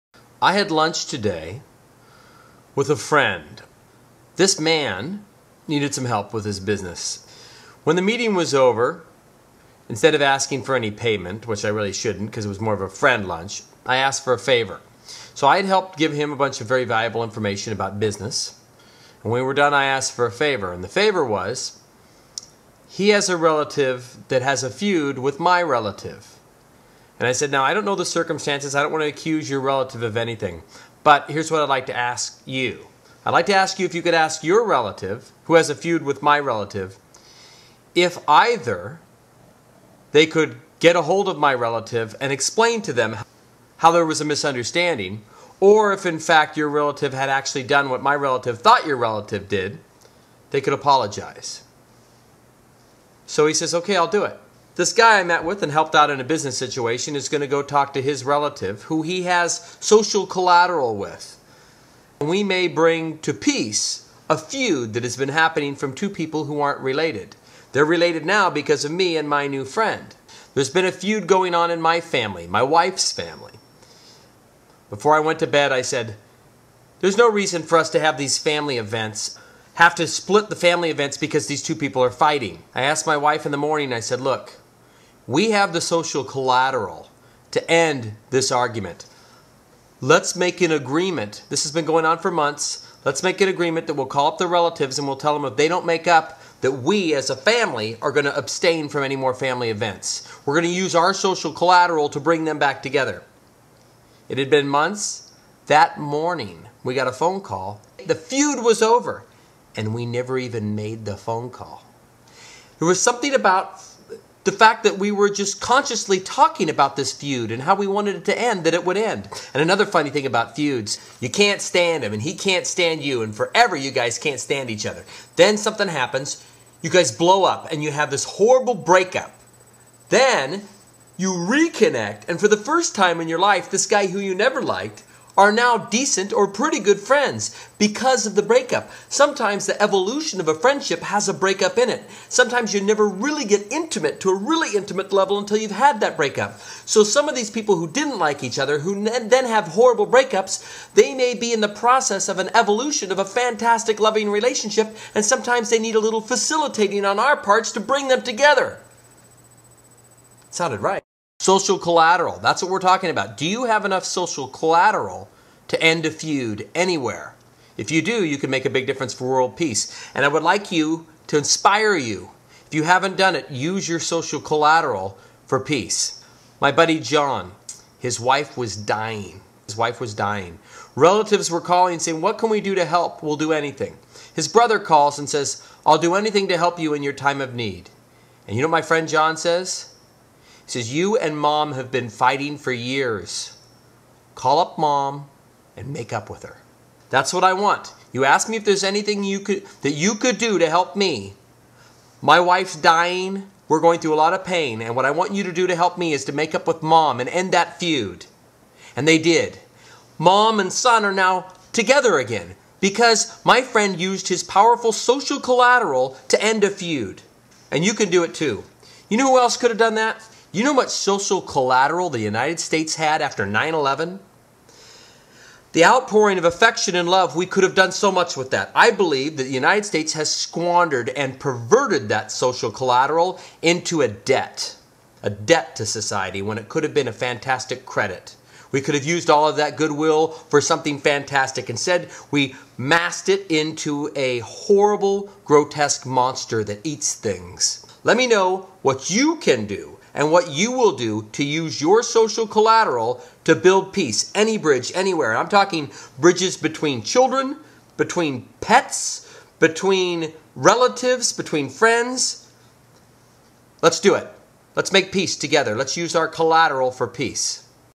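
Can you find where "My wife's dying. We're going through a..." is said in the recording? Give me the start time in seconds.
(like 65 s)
202 s.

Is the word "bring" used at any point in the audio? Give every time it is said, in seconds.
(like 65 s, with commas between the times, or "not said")
62 s, 102 s, 157 s.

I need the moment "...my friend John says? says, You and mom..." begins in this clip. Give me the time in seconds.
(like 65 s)
188 s.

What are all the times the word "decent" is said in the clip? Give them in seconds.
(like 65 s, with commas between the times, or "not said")
135 s.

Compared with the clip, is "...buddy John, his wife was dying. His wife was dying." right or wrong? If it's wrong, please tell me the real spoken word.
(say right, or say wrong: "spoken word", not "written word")
right.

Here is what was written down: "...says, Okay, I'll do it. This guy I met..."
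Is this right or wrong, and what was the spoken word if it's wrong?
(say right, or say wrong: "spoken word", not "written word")
right.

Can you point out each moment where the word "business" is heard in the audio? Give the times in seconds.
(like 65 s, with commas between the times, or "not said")
6 s, 17 s, 56 s.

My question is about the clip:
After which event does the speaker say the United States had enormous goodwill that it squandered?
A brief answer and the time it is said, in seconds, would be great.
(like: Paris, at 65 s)
9/11, at 223 s.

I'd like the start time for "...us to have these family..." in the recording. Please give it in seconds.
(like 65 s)
77 s.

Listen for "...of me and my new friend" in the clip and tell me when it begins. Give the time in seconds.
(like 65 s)
68 s.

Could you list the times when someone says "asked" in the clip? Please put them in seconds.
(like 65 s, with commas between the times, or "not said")
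13 s, 19 s, 82 s.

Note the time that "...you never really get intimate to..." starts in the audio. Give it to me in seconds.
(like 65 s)
142 s.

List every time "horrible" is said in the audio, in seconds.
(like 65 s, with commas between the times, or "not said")
128 s, 149 s, 244 s.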